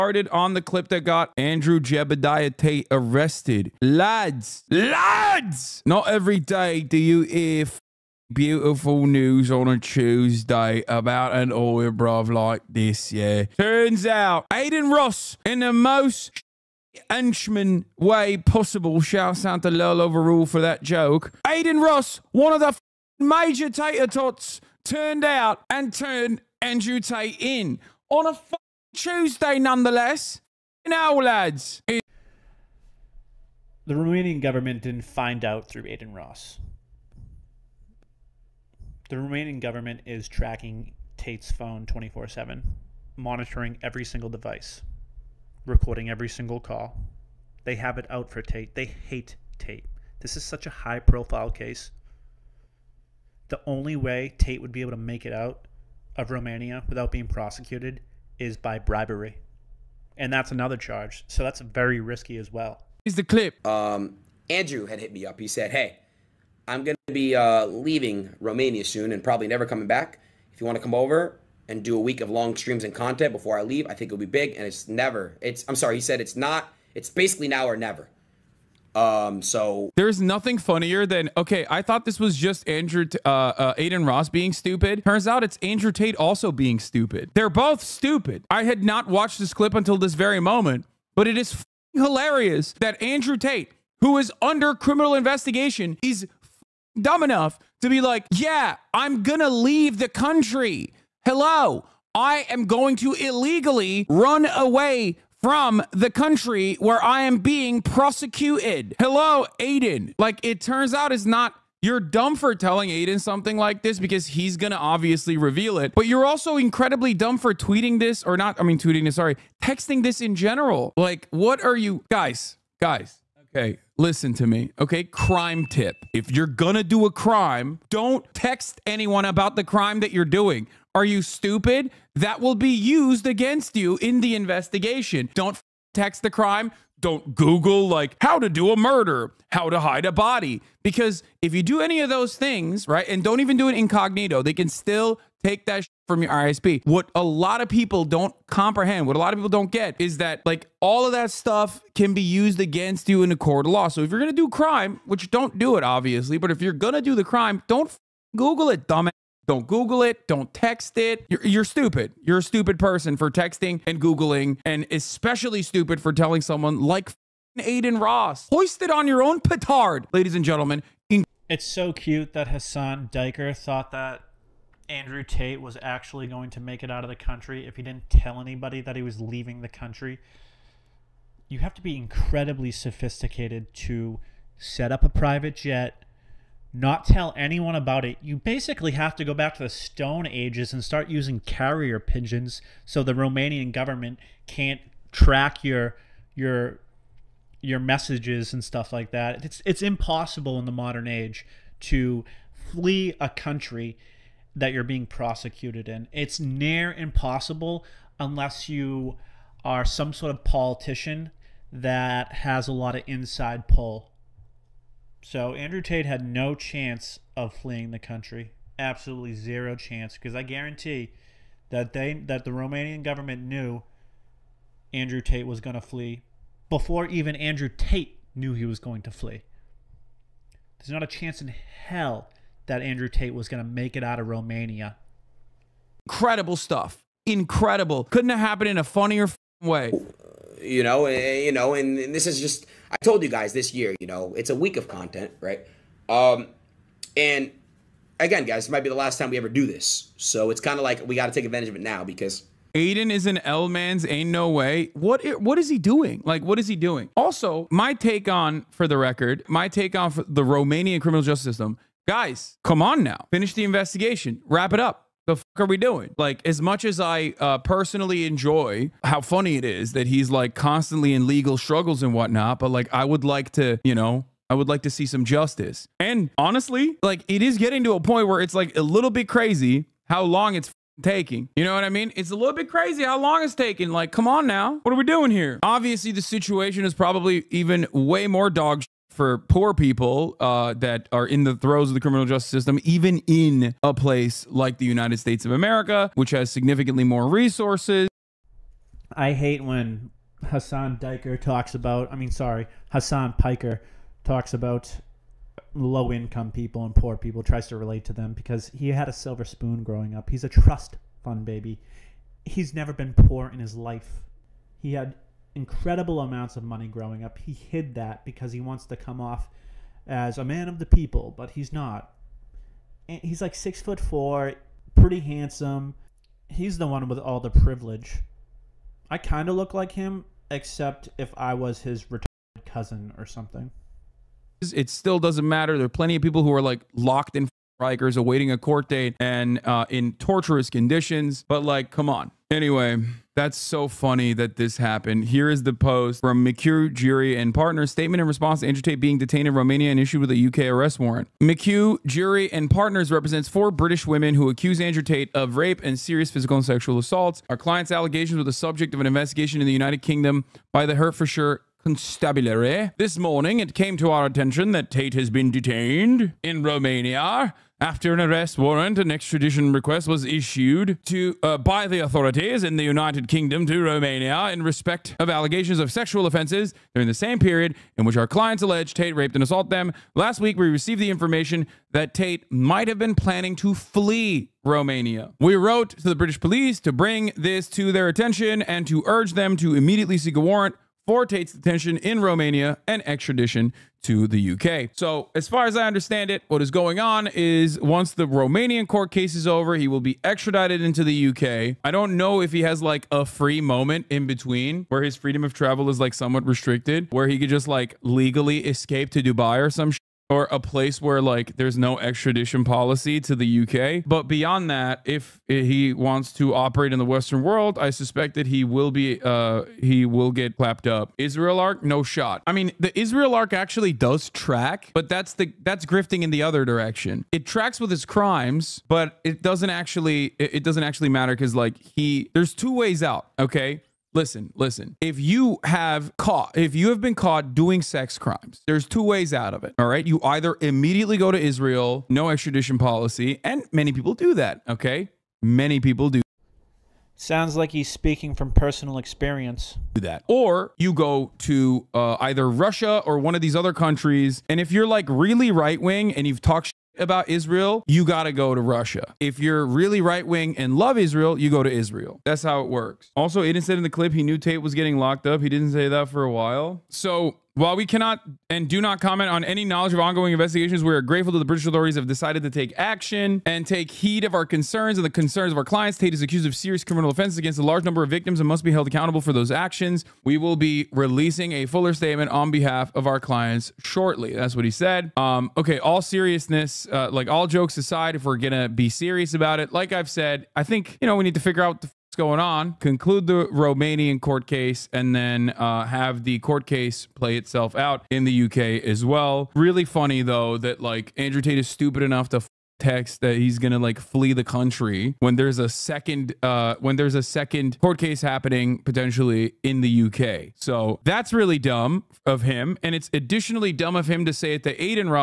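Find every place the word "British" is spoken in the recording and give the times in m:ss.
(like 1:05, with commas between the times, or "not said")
5:53, 6:26, 7:51.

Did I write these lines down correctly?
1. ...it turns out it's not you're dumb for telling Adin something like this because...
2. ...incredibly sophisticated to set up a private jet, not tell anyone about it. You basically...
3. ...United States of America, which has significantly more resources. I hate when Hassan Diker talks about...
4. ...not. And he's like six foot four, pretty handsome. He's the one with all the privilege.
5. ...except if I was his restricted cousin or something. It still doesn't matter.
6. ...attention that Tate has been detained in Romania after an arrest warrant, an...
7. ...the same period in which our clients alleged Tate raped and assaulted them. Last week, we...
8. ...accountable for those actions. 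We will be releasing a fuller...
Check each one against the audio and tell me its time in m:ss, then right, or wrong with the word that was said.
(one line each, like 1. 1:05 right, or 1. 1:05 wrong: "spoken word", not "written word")
1. 1:50 right
2. 3:01 right
3. 4:54 right
4. 5:21 right
5. 5:30 wrong: "retarded", not "restricted"
6. 6:04 right
7. 6:17 right
8. 7:58 right.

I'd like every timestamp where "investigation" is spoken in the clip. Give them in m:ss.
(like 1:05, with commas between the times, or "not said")
1:35, 2:14, 4:23, 5:59, 7:50.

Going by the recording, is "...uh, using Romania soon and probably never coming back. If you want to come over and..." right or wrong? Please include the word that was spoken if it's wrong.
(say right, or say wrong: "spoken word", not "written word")
wrong: "leaving", not "using".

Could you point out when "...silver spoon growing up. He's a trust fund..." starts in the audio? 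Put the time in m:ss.
5:09.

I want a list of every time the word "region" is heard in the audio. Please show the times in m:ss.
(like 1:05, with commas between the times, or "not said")
not said.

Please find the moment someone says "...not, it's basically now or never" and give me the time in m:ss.
1:16.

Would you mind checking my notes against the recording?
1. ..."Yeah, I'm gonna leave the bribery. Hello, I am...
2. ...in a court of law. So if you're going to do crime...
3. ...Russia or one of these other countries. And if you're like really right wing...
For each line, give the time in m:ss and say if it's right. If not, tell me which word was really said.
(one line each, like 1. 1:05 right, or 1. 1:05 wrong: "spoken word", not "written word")
1. 1:38 wrong: "country", not "bribery"
2. 2:33 right
3. 7:32 right.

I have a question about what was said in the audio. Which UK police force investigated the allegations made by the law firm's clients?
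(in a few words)
Hertfordshire Constabulary.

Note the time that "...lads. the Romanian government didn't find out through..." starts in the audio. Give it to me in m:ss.
0:31.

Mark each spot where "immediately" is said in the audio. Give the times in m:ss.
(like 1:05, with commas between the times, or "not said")
6:29, 7:20.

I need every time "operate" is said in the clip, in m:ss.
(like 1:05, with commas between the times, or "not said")
6:56.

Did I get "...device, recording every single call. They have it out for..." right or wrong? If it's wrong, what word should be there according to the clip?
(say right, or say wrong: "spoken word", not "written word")
right.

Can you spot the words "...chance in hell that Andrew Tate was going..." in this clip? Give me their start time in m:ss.
3:51.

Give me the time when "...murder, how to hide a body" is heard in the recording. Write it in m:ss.
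2:18.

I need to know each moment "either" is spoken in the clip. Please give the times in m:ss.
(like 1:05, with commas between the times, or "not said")
7:20, 7:32.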